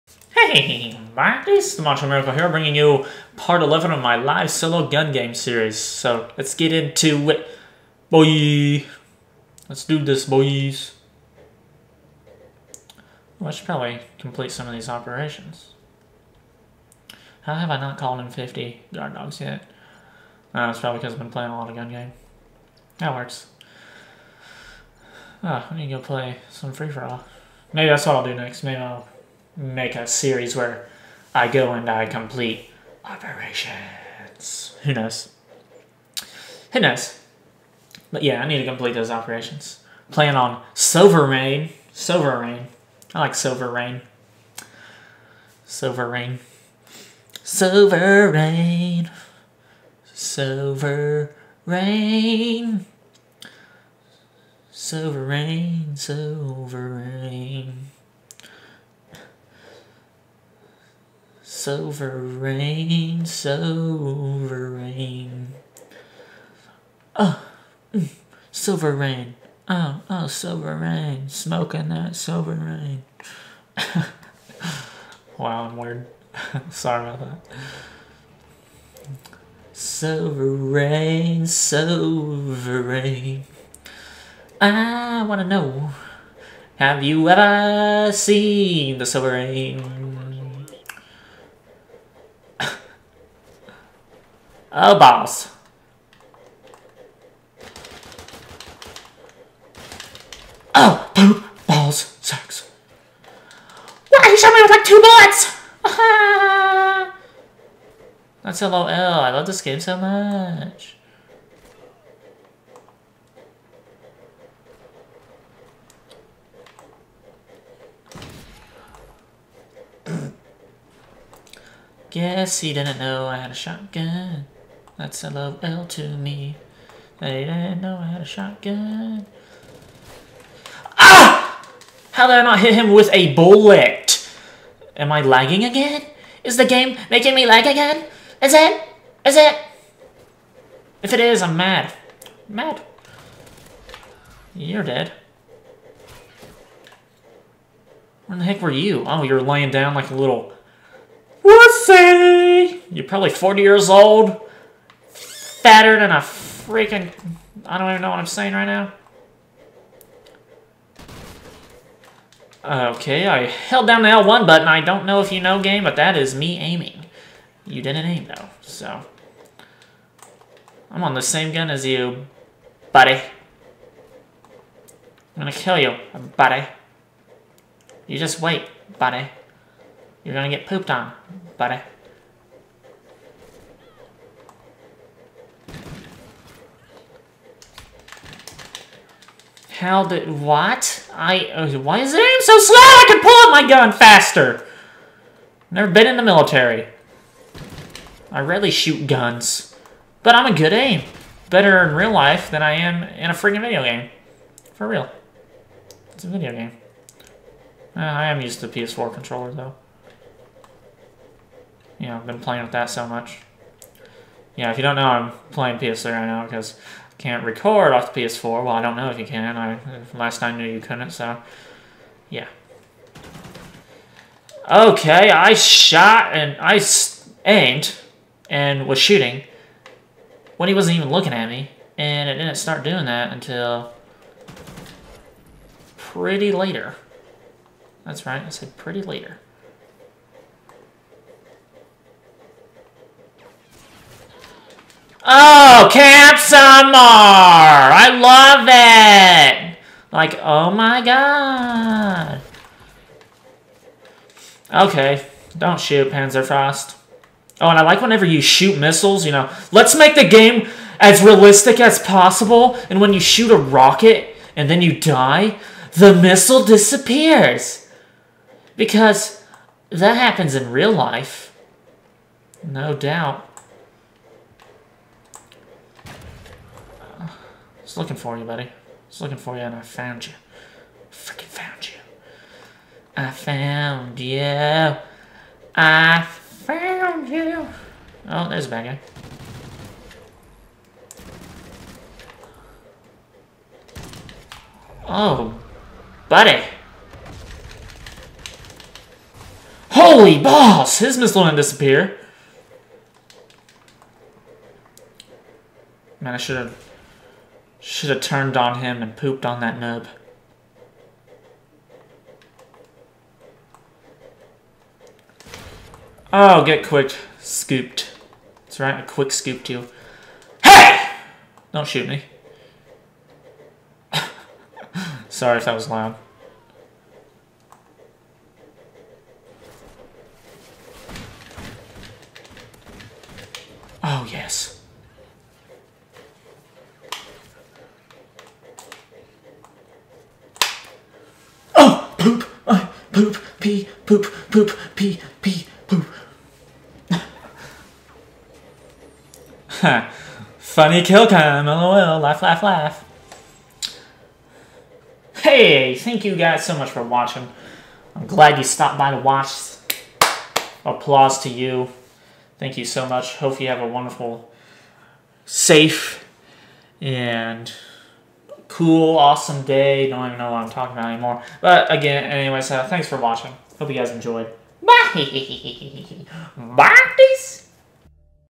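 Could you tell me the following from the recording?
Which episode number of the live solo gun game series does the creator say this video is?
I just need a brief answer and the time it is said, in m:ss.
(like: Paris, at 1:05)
11, at 0:03.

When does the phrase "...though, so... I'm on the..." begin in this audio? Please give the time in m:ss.
2:48.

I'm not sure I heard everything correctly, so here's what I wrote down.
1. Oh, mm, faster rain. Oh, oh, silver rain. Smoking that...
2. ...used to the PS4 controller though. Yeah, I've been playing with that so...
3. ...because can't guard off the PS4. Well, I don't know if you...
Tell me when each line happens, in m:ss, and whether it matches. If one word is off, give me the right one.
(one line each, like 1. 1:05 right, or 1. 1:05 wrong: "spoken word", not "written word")
1. 1:07 wrong: "silver", not "faster"
2. 3:28 right
3. 3:36 wrong: "record", not "guard".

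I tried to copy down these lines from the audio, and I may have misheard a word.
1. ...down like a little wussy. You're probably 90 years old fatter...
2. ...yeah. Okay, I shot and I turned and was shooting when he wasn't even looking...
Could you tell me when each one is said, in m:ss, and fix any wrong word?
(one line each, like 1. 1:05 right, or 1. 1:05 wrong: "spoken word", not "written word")
1. 2:29 wrong: "40", not "90"
2. 3:42 wrong: "aimed", not "turned".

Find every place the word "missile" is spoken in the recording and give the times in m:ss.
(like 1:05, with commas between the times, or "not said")
4:18, 4:26, 5:01.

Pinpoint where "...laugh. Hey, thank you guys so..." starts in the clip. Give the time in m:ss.
5:52.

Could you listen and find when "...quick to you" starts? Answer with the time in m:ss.
5:19.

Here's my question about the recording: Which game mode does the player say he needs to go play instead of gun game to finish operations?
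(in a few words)
free-for-all.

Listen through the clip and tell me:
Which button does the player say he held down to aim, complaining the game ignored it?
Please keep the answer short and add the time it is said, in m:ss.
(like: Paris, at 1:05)
L1, at 2:44.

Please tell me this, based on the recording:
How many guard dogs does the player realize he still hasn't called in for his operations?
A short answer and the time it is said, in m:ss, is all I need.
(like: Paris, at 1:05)
50, at 0:18.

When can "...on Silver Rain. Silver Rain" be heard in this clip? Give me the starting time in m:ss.
0:40.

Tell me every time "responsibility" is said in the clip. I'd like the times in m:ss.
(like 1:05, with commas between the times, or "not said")
not said.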